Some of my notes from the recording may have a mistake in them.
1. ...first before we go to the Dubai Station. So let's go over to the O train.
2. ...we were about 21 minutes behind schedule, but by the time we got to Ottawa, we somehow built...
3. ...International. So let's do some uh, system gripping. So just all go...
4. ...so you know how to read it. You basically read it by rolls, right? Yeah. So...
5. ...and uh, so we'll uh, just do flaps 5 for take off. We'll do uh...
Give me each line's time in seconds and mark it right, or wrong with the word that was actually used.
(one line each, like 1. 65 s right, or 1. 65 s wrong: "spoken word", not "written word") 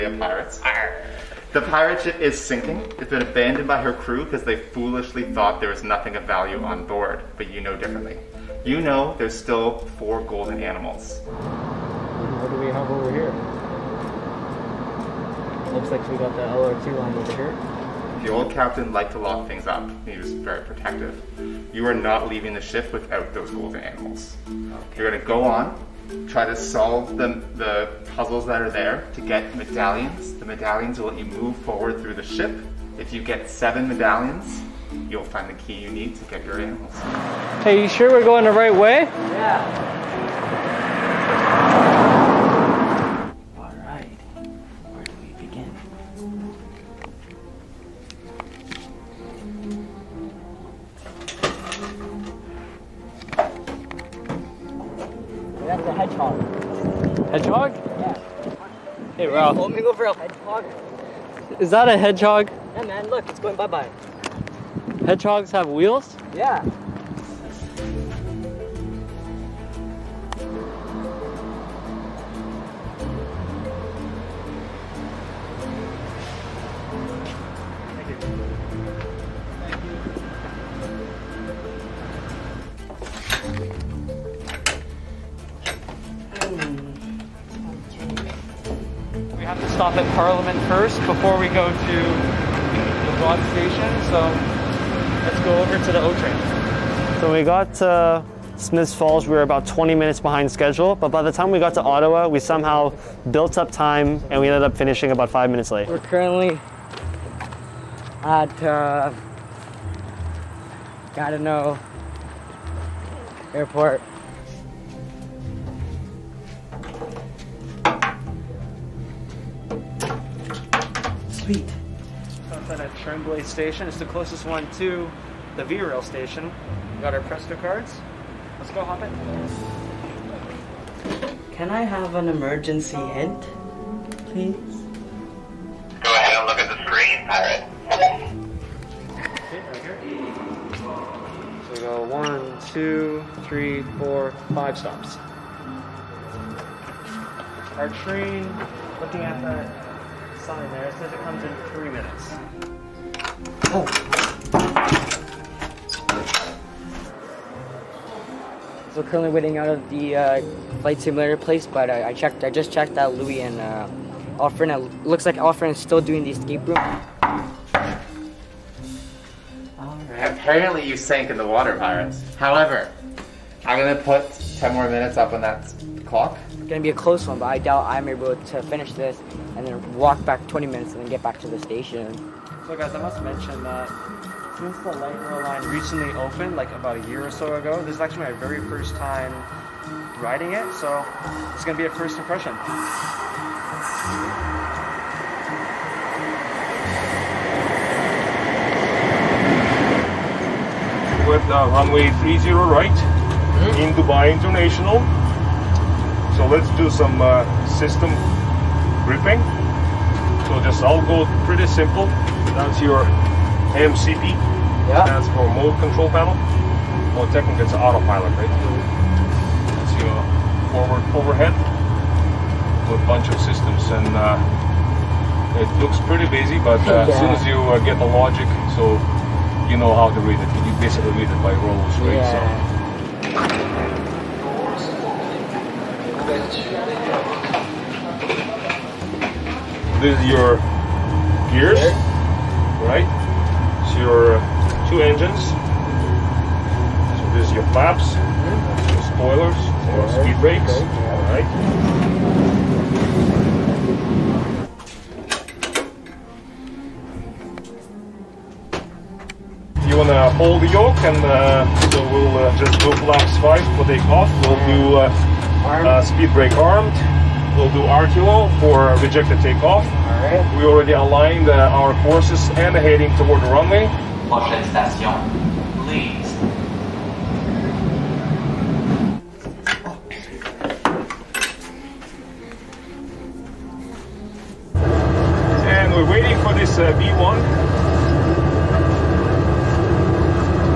1. 90 s wrong: "Broad", not "Dubai"
2. 99 s wrong: "20", not "21"
3. 204 s right
4. 228 s right
5. 261 s right.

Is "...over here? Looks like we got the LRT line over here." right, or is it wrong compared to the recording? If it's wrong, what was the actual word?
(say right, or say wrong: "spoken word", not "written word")
right.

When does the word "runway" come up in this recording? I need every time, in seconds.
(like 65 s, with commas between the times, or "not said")
201 s, 273 s.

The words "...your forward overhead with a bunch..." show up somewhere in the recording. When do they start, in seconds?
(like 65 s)
219 s.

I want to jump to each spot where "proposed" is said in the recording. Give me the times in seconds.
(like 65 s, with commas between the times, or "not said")
not said.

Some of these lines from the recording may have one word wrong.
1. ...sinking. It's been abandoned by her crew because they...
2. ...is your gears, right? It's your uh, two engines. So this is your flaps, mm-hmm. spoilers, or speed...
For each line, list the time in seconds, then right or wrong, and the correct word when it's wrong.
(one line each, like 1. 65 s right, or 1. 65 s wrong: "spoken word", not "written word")
1. 2 s right
2. 240 s right.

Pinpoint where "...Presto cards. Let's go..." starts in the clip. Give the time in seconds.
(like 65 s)
127 s.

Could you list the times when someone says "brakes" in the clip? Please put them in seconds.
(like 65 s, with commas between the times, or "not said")
250 s, 266 s.